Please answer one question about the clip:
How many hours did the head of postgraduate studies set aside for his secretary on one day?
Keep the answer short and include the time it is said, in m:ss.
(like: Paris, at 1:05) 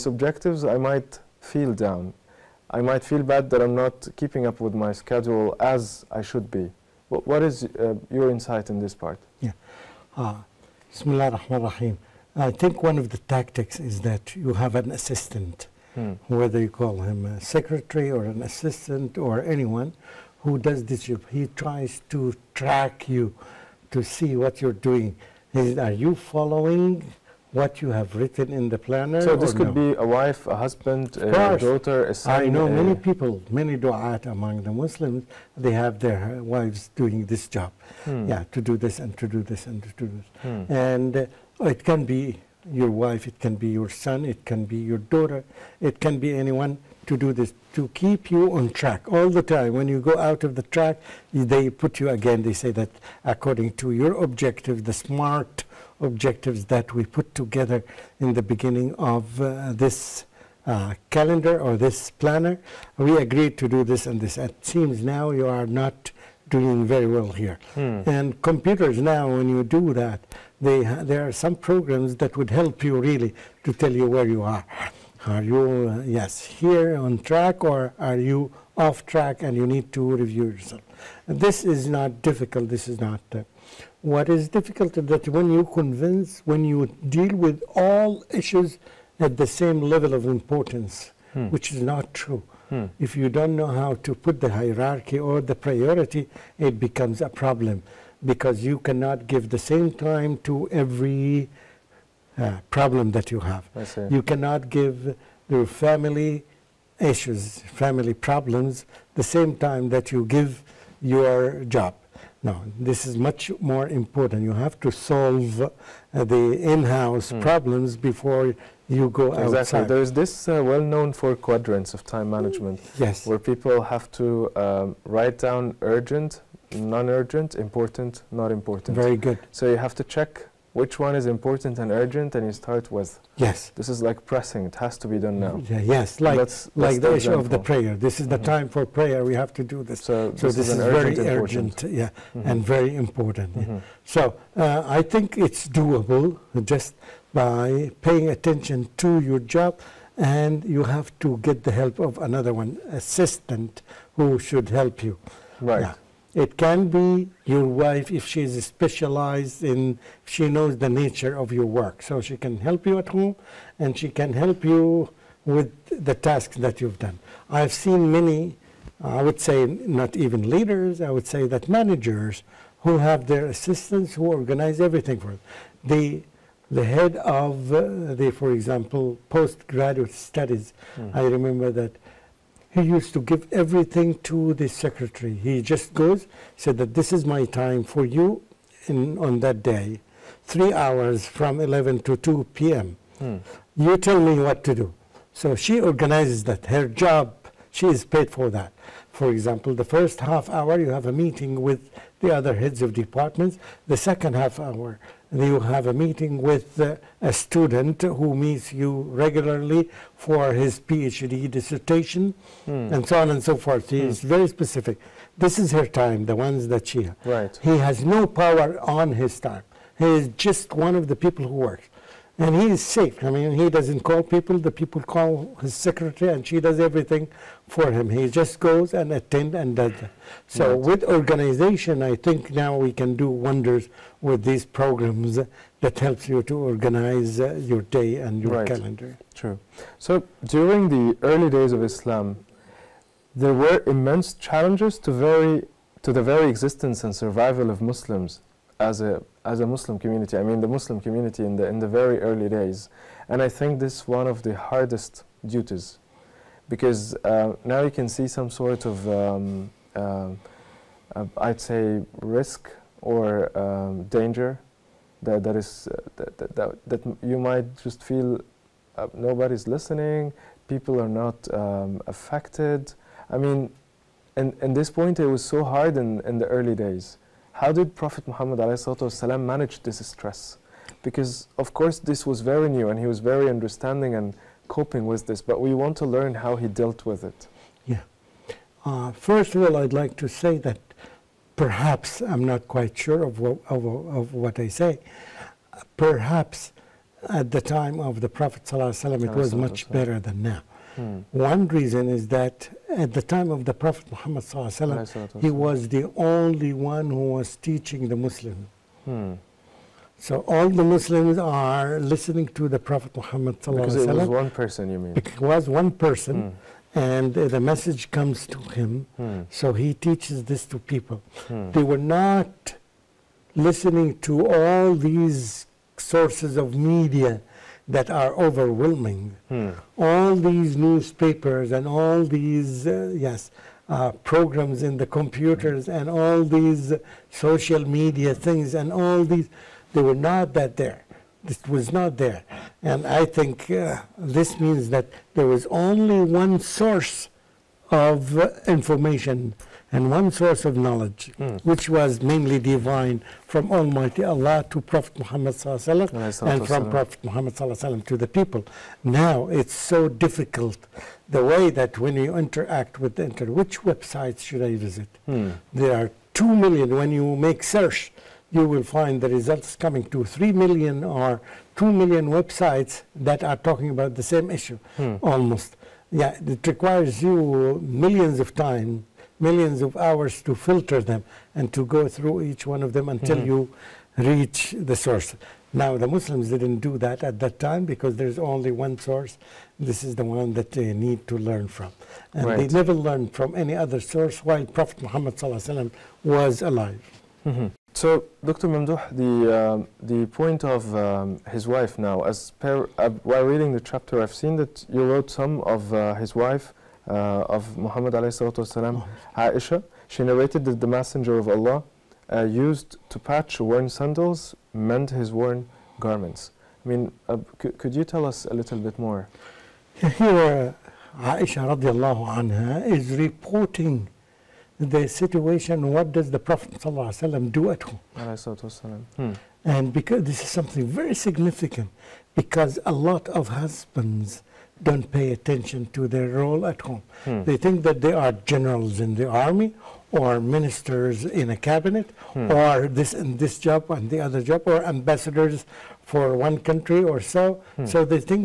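3, at 3:10.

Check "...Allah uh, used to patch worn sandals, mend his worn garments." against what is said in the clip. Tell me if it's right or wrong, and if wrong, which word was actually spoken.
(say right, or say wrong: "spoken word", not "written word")
right.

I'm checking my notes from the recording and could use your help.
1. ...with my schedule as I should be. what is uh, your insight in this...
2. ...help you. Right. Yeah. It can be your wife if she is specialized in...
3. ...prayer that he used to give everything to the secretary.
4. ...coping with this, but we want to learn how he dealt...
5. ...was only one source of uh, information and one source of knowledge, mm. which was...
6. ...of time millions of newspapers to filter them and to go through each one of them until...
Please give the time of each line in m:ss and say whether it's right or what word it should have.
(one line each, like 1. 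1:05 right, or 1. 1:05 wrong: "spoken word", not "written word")
1. 0:04 right
2. 2:34 right
3. 3:01 wrong: "remember", not "prayer"
4. 4:44 right
5. 5:45 right
6. 6:18 wrong: "hours", not "newspapers".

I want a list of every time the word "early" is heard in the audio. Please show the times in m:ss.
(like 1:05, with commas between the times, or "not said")
4:01, 4:12, 4:36.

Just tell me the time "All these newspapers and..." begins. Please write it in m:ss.
5:29.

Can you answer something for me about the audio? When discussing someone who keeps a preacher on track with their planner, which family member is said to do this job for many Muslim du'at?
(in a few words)
Their wives.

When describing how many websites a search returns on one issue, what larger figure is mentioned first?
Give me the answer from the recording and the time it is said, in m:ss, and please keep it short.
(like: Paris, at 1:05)
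3 million, at 6:10.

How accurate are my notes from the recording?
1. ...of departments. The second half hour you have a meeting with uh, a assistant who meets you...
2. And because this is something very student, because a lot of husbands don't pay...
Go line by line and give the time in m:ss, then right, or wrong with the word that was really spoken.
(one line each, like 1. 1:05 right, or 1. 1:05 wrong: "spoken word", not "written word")
1. 3:22 wrong: "student", not "assistant"
2. 7:09 wrong: "significant", not "student".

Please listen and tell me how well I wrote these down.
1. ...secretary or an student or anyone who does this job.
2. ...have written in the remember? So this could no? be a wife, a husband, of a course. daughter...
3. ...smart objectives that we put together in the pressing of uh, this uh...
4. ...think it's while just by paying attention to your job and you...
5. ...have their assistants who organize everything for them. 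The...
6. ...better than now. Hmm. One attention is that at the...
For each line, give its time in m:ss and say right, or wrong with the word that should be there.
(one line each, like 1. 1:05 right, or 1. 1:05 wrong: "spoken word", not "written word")
1. 0:17 wrong: "assistant", not "student"
2. 0:27 wrong: "planner", not "remember"
3. 0:54 wrong: "beginning", not "pressing"
4. 2:25 wrong: "doable", not "while"
5. 2:52 right
6. 4:59 wrong: "reason", not "attention".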